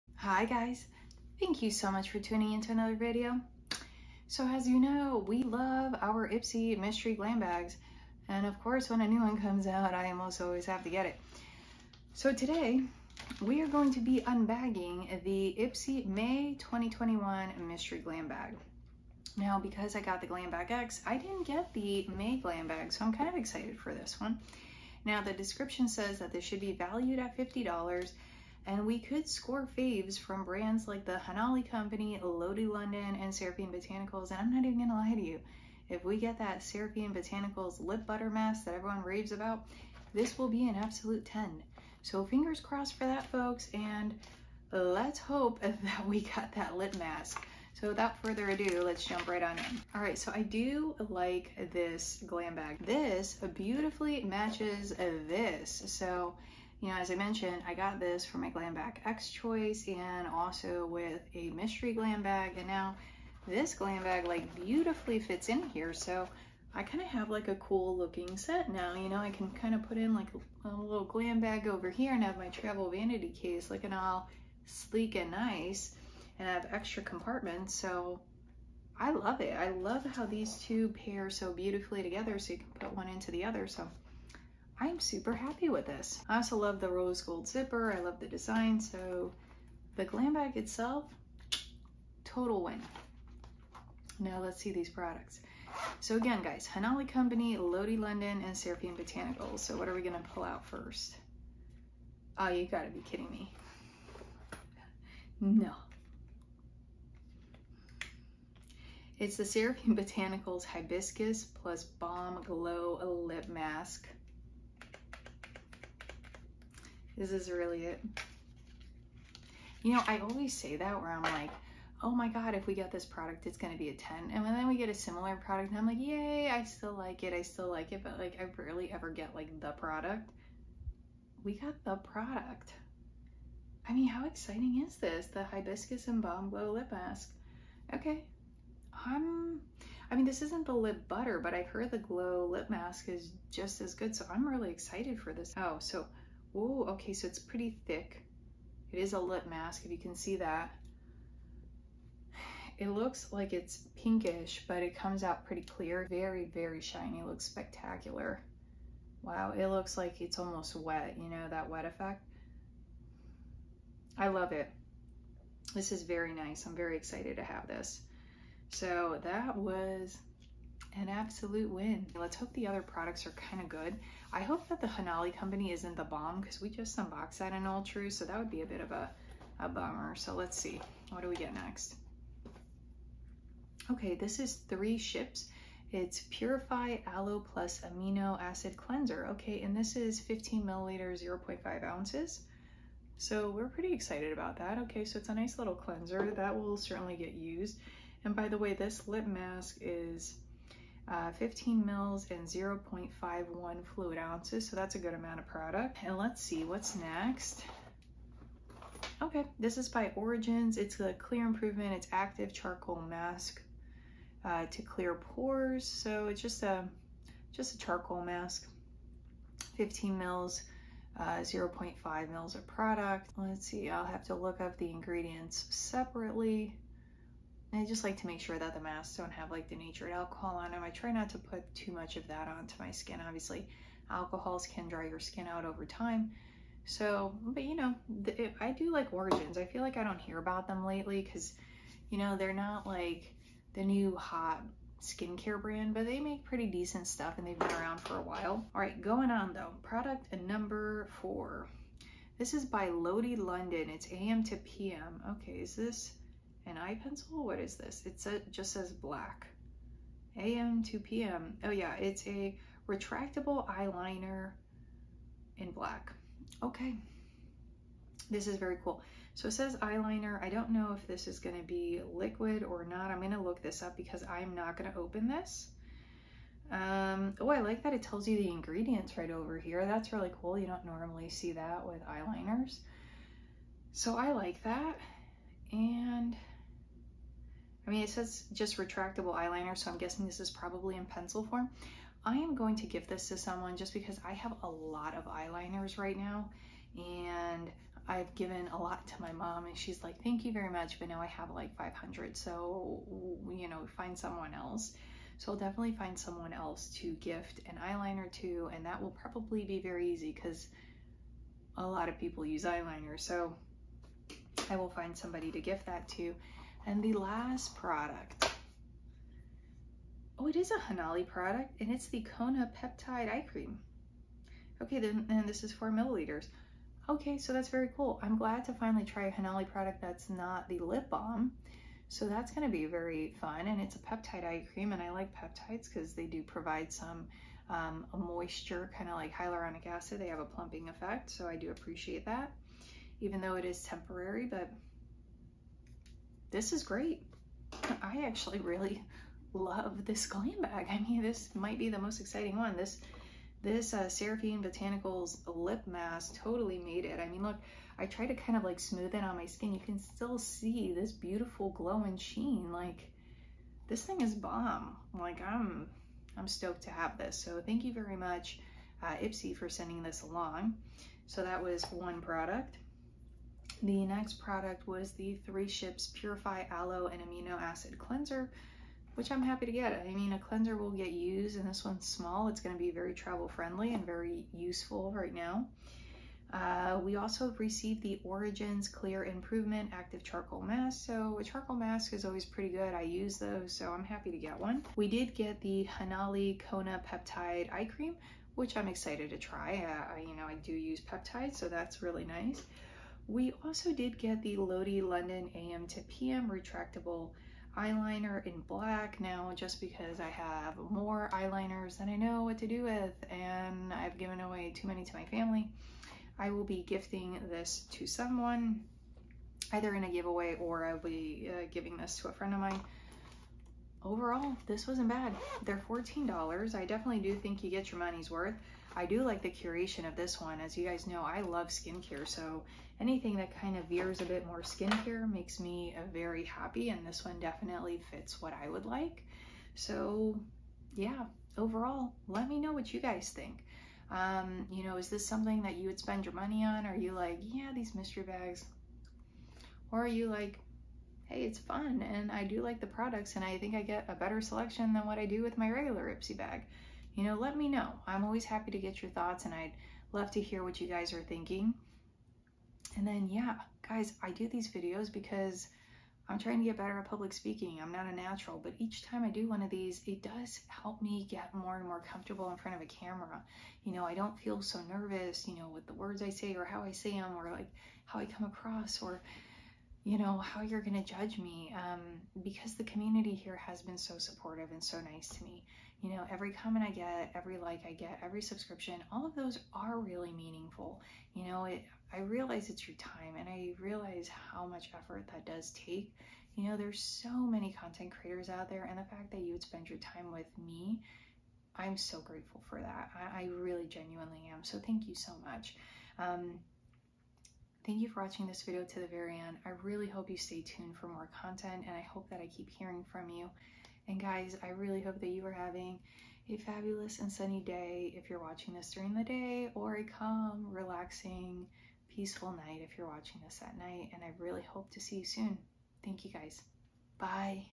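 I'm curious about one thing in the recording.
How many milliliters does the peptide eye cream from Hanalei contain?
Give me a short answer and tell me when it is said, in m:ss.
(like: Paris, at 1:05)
4, at 5:25.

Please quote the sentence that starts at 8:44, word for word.
And I really hope to see you soon.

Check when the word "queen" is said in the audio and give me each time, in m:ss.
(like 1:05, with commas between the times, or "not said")
not said.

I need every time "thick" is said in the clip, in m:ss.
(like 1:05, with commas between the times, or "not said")
2:27.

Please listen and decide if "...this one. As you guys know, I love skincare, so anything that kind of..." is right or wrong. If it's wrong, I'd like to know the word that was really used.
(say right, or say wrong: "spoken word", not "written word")
right.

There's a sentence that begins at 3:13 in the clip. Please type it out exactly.
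So we're pretty excited about that.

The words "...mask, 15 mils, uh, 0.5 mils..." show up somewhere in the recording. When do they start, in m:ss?
3:38.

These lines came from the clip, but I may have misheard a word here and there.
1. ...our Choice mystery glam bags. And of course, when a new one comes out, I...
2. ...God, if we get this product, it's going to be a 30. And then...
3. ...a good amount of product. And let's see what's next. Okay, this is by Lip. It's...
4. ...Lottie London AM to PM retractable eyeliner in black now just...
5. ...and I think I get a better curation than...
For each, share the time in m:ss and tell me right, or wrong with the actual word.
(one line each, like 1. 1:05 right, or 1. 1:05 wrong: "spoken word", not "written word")
1. 0:05 wrong: "Ipsy", not "Choice"
2. 2:02 wrong: "10", not "30"
3. 3:24 wrong: "Origins", not "Lip"
4. 6:44 right
5. 7:33 wrong: "selection", not "curation".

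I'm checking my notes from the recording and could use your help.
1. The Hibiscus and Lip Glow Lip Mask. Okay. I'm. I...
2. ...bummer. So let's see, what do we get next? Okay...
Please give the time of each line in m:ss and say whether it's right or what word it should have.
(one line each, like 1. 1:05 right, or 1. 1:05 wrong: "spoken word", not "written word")
1. 2:15 wrong: "Balm", not "Lip"
2. 2:59 right.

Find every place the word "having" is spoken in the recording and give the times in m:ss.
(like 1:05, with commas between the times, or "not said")
8:35.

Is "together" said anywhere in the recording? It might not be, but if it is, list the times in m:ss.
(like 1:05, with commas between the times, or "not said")
1:22.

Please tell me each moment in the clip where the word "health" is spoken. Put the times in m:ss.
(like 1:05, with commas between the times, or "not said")
not said.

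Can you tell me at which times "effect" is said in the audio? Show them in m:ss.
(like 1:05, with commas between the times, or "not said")
2:41, 5:40.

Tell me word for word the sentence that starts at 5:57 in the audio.
I mean, look, I tried to kind of like smooth it on my skin.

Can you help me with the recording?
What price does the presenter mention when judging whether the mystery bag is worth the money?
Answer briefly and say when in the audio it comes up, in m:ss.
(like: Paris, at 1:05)
$14, at 7:05.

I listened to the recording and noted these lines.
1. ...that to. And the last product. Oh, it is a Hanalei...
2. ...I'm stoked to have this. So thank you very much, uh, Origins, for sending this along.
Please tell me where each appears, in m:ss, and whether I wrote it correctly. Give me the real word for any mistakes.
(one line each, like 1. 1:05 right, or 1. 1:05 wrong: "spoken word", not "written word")
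1. 5:15 right
2. 6:06 wrong: "Ipsy", not "Origins".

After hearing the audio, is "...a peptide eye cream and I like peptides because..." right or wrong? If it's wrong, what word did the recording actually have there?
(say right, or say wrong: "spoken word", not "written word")
right.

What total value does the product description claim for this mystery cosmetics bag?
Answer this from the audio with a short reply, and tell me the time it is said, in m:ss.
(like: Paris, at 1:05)
$50, at 0:27.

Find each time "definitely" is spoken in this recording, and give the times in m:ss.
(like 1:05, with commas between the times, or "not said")
5:05, 7:06, 7:17.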